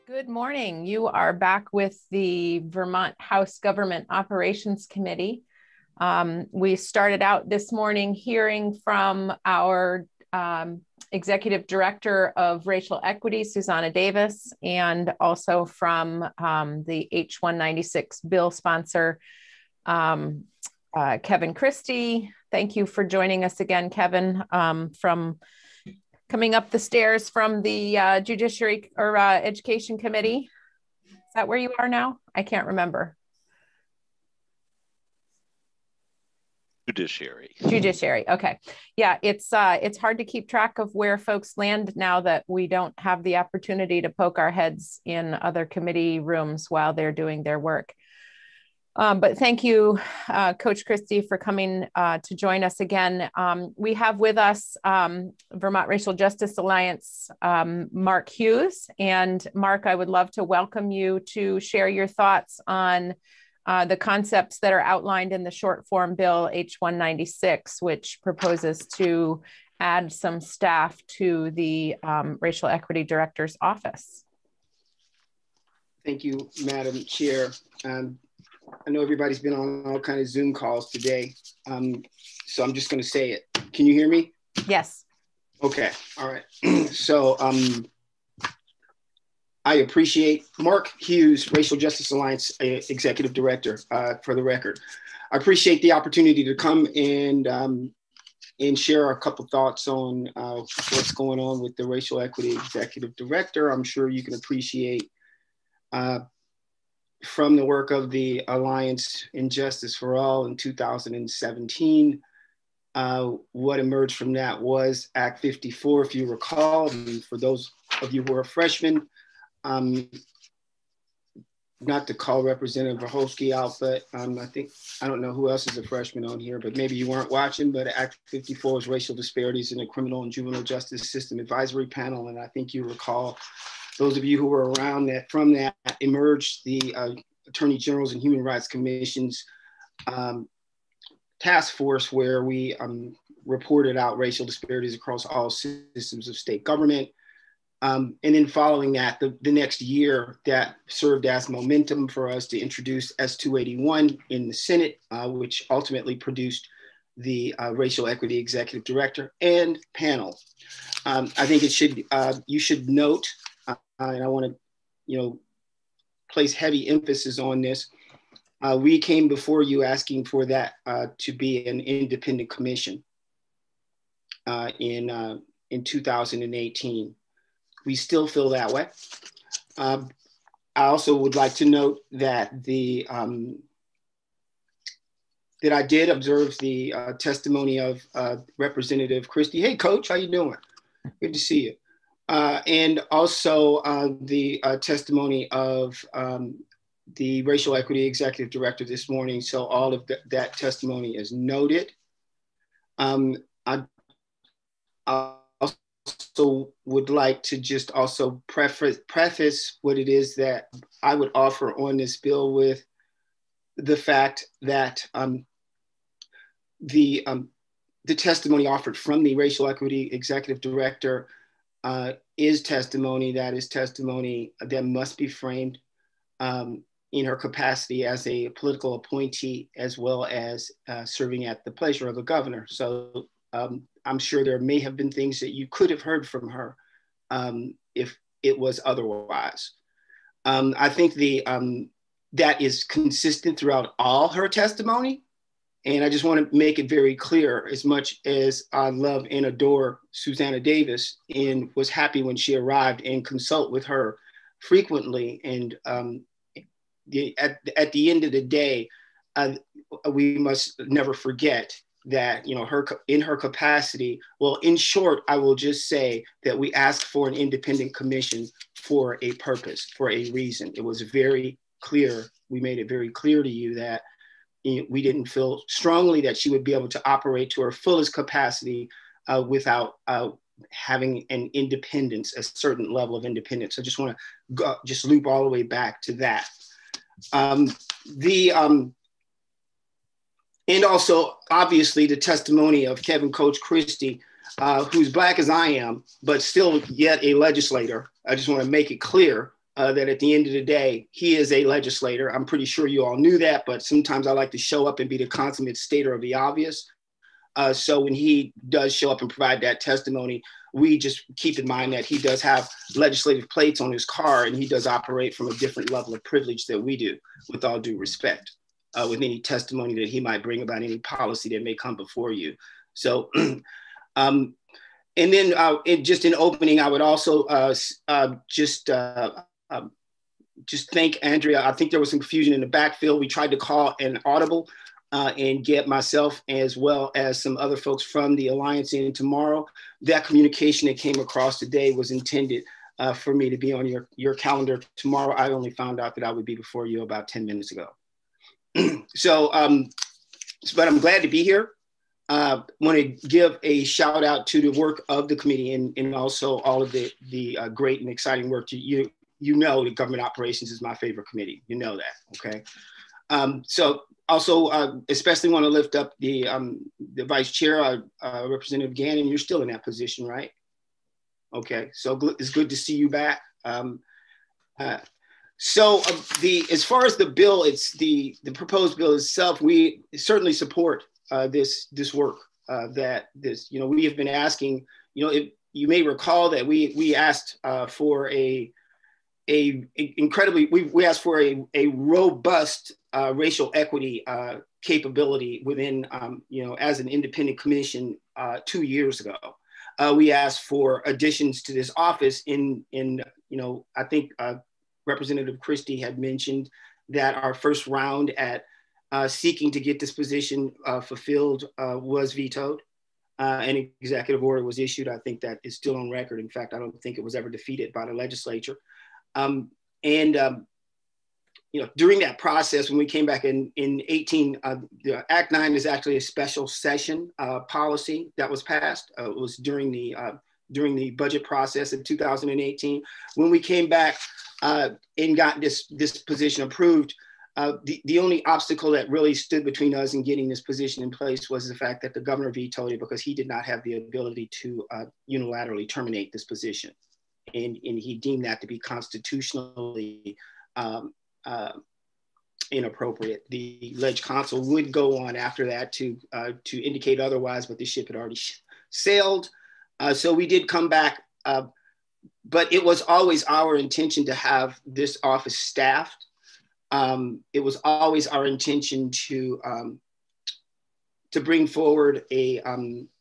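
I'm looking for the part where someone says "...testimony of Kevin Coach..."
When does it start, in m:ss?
4:52.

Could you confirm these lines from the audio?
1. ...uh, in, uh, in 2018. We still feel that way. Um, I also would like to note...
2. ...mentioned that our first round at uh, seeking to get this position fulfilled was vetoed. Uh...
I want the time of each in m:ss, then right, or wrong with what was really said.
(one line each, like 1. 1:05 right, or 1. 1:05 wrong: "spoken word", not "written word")
1. 2:54 right
2. 6:46 right.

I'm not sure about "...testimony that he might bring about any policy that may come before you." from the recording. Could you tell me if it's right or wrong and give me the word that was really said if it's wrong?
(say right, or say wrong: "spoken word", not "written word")
right.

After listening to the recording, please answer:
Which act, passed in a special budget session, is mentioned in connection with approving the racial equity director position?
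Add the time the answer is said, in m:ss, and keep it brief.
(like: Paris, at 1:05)
Act Nine, at 7:05.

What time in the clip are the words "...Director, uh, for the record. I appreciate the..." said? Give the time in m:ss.
1:33.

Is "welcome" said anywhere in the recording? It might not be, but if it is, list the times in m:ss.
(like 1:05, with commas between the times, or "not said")
1:00.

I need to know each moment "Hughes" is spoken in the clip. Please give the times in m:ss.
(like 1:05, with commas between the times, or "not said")
0:58, 1:30.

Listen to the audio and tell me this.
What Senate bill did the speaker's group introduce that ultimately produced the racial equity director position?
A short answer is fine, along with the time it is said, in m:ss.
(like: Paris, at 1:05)
S281, at 2:33.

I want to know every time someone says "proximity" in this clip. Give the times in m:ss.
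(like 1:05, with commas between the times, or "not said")
not said.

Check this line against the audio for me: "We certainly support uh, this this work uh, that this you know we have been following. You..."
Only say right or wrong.
wrong.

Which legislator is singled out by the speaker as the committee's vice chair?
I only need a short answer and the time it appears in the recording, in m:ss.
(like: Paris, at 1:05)
Representative Gannon, at 6:08.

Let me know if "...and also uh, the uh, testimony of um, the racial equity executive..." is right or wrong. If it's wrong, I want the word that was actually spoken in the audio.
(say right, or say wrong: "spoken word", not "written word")
right.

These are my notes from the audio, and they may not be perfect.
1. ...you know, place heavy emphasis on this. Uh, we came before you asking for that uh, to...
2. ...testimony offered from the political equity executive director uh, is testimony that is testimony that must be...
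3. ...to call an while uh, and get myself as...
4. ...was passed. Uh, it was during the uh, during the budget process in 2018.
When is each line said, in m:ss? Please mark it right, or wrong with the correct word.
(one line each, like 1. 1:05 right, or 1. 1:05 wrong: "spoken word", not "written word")
1. 2:45 right
2. 3:38 wrong: "racial", not "political"
3. 5:33 wrong: "audible", not "while"
4. 7:08 right.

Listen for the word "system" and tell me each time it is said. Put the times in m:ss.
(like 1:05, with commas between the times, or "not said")
2:11, 2:25.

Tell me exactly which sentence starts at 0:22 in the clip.
Thank you for joining us again, Kevin, um, from coming up the stairs from the uh, Judiciary or uh, Education Committee.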